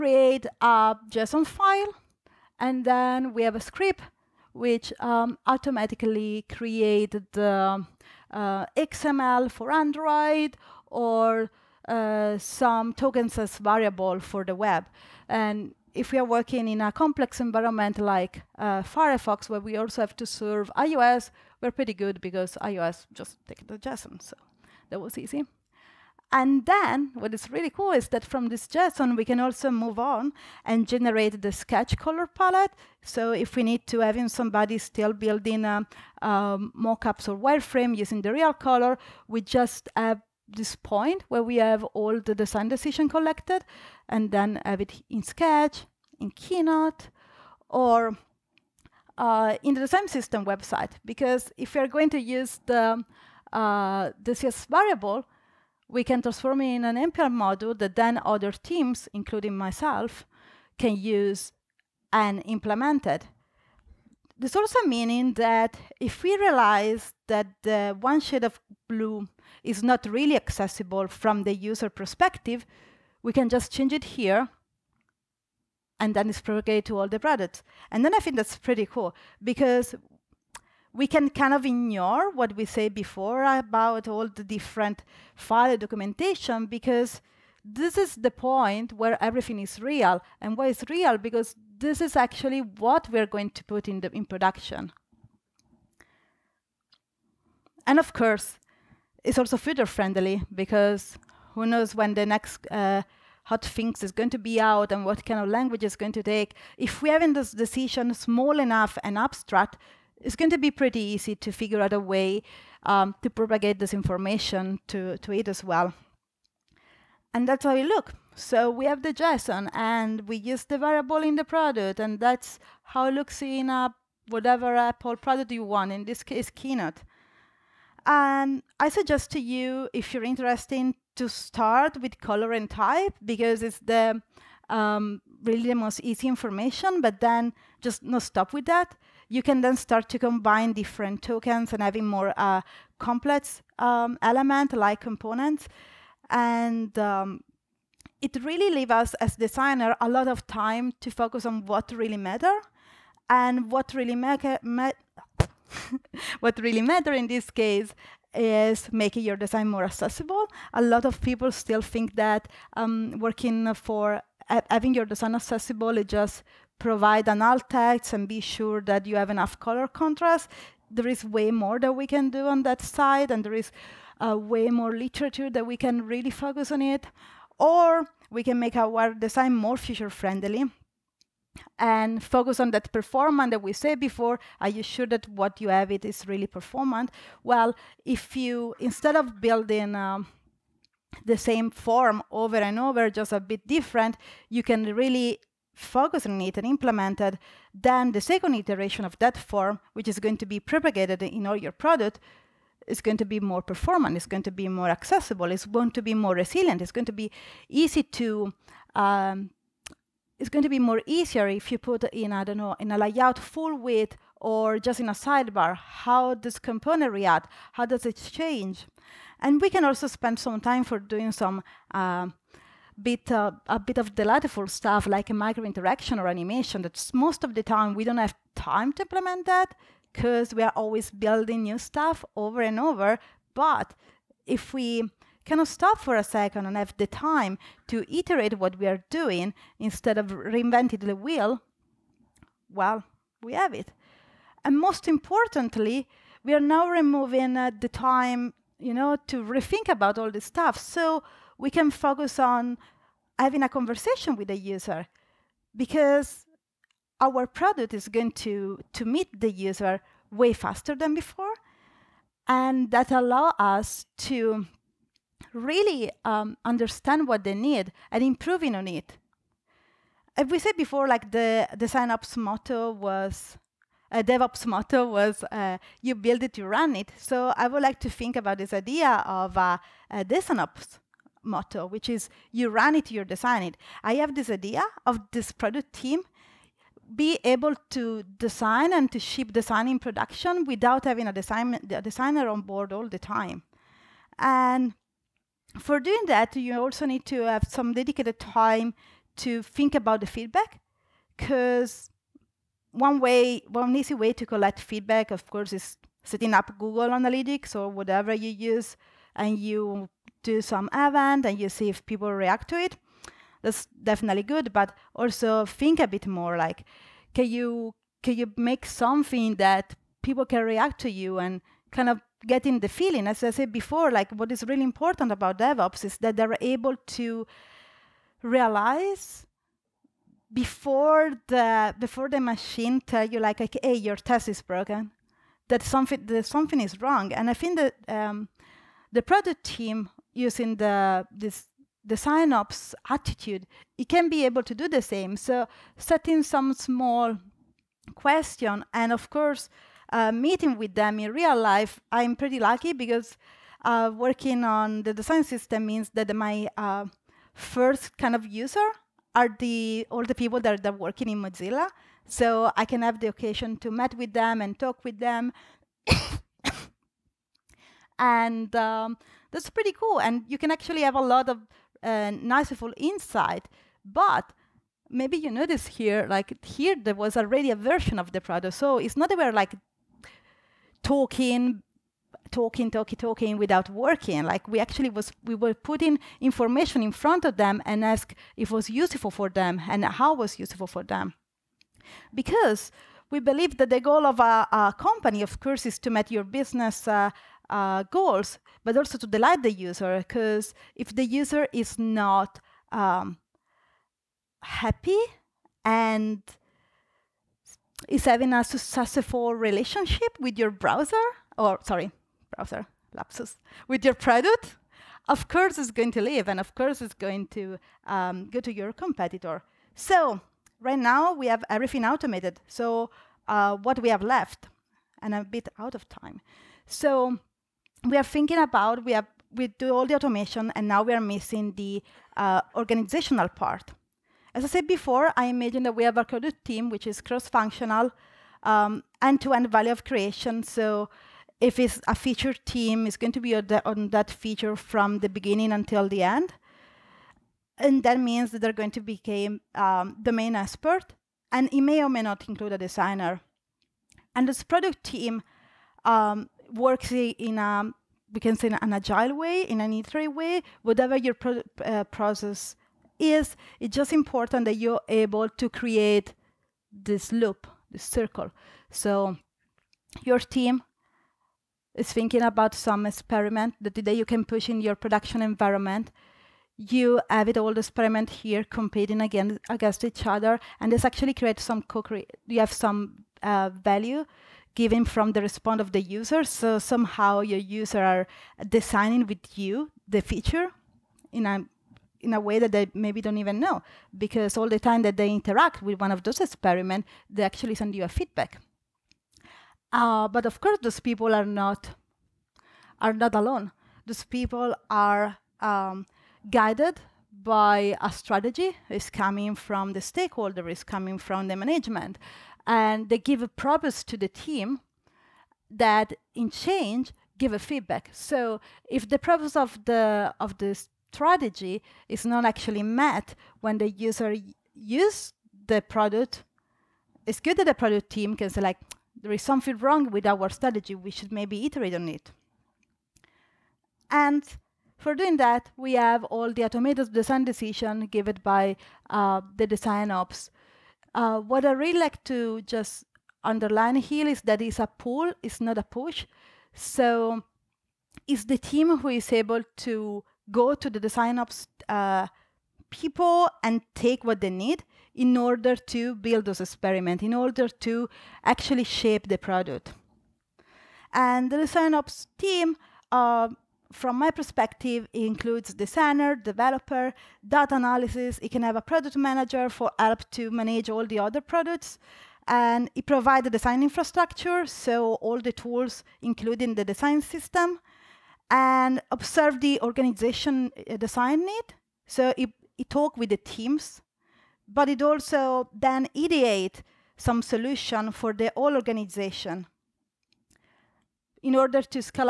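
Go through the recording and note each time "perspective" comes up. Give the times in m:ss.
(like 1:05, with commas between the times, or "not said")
1:11, 9:24.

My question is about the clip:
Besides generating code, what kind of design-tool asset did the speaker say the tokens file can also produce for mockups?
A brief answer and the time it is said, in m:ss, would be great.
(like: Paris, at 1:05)
Sketch color palette, at 0:31.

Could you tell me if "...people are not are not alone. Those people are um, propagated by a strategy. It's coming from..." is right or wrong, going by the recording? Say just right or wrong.
wrong.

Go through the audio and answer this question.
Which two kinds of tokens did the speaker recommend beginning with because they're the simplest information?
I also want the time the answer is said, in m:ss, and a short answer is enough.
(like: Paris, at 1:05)
color and type, at 2:12.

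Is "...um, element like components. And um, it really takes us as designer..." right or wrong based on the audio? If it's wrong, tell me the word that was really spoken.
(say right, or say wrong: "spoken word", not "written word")
wrong: "leaves", not "takes".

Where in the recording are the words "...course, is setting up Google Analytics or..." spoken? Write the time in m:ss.
5:05.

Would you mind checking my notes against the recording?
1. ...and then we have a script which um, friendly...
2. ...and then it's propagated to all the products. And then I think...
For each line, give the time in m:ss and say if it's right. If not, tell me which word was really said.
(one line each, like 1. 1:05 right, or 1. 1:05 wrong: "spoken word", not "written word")
1. 0:02 wrong: "automatically", not "friendly"
2. 1:15 right.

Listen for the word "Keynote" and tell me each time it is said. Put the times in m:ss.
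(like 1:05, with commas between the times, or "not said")
0:46, 2:06.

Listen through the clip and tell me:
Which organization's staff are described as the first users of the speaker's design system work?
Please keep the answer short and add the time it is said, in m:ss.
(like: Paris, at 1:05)
Mozilla, at 6:01.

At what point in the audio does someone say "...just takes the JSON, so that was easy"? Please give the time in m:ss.
0:23.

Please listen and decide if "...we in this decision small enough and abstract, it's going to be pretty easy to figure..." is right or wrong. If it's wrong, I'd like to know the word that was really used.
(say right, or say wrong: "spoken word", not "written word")
right.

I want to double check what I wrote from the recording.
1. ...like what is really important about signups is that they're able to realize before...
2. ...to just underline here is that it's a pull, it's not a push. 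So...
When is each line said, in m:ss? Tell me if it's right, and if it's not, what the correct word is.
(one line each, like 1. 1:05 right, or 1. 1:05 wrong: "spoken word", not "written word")
1. 5:24 wrong: "devops", not "signups"
2. 9:02 right.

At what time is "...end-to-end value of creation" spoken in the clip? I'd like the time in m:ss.
7:19.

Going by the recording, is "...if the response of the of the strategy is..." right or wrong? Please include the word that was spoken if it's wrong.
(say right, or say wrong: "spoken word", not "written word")
wrong: "purpose", not "response".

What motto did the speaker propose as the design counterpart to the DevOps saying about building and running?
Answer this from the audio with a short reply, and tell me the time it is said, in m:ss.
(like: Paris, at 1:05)
you run it, you design it, at 4:42.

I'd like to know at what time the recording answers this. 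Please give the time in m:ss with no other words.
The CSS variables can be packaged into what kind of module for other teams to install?
0:57.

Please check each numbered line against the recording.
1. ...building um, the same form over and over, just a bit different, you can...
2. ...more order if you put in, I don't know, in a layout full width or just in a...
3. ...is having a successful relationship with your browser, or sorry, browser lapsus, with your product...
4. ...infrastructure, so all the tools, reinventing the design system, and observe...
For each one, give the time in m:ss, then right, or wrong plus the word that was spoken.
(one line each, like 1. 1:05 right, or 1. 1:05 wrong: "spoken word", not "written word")
1. 3:09 right
2. 3:30 wrong: "easier", not "order"
3. 6:48 right
4. 9:33 wrong: "including", not "reinventing".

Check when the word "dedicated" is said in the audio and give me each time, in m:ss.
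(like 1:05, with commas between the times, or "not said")
4:57.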